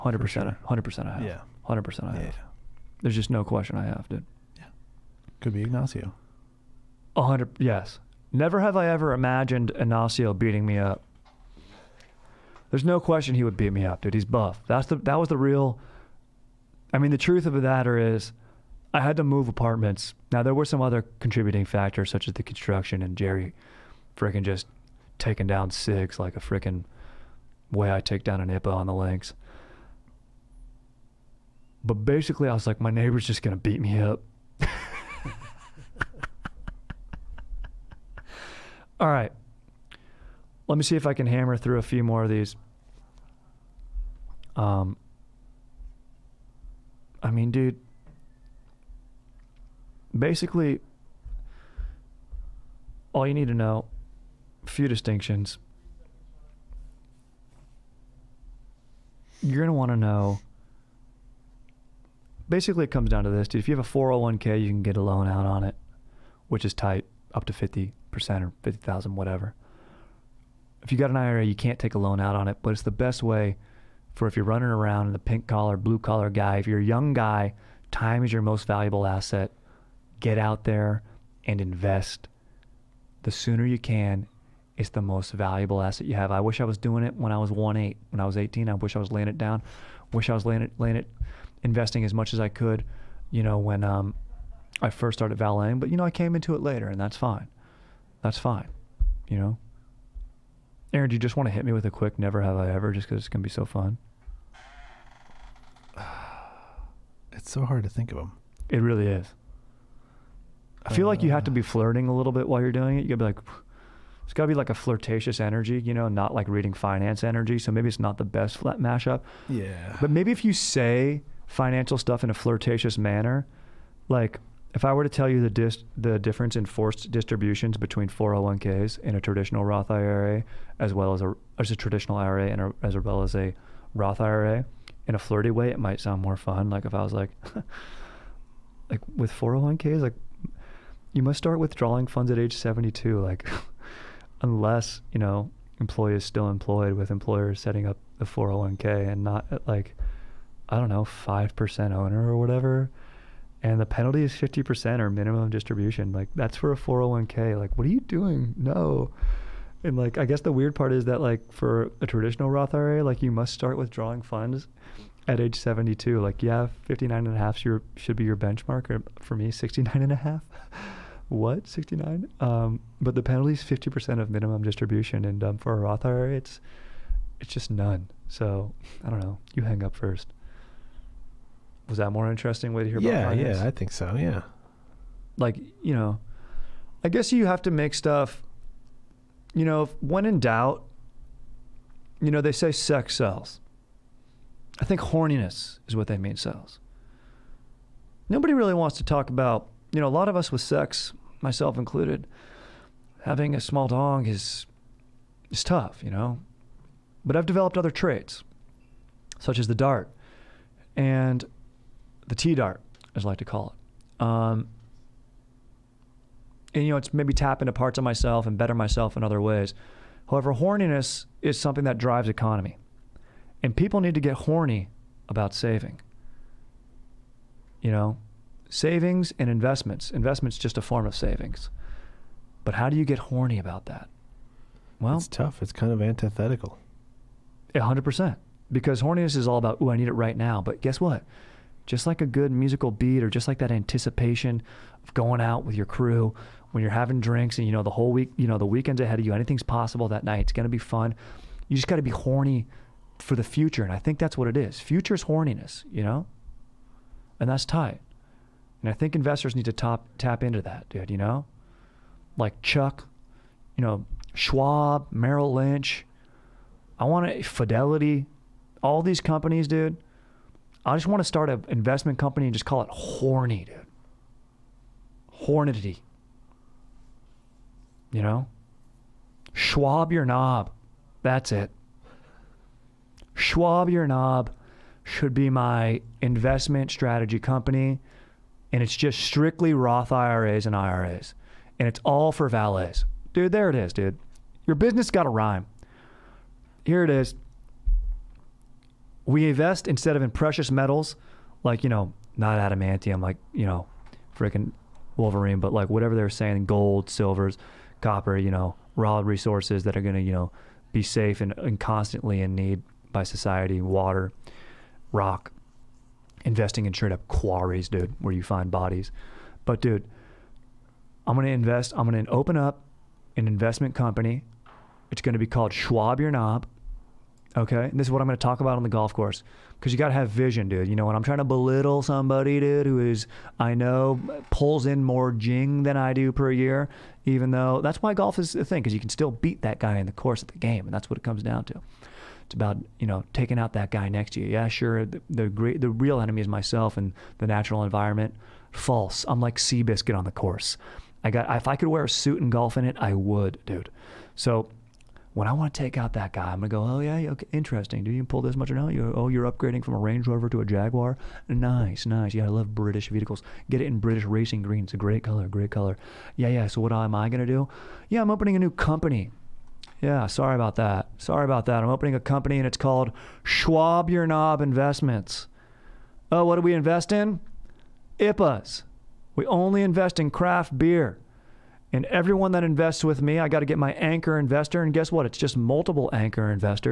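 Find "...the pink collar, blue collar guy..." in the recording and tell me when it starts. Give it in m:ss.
1:15.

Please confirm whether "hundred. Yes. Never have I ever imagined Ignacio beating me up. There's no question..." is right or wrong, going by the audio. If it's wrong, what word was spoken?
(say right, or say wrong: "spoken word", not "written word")
right.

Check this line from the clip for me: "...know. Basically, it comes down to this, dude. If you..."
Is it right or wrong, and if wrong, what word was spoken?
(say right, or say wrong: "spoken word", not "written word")
right.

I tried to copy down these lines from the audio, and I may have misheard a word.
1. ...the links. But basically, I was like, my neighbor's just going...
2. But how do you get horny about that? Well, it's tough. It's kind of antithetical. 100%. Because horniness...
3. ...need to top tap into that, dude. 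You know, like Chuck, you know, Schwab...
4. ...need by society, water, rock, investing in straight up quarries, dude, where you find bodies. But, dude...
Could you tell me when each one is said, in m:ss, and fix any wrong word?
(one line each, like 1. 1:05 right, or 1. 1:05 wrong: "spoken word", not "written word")
1. 0:28 right
2. 3:52 right
3. 4:19 right
4. 5:12 right.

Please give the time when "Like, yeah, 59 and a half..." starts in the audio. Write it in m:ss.
2:46.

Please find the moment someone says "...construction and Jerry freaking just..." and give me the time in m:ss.
0:22.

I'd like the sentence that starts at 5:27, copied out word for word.
Okay, this is what I'm going to talk about on the golf course because you got to have vision, dude.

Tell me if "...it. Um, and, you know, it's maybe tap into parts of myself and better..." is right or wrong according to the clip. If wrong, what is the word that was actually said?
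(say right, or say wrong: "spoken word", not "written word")
right.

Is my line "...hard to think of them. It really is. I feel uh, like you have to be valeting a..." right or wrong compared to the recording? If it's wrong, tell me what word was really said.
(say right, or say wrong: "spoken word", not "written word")
wrong: "flirting", not "valeting".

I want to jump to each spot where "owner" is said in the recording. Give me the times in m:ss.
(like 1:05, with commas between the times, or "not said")
2:31.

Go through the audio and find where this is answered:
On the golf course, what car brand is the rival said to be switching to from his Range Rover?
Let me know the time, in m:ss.
6:00.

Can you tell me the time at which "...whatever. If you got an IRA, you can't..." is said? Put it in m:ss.
1:09.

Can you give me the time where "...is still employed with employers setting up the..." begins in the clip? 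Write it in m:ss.
2:26.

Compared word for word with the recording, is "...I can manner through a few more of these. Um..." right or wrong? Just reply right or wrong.
wrong.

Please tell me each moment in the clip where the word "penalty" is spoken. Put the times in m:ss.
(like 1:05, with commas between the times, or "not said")
2:33, 2:53.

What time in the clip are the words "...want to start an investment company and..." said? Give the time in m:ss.
4:31.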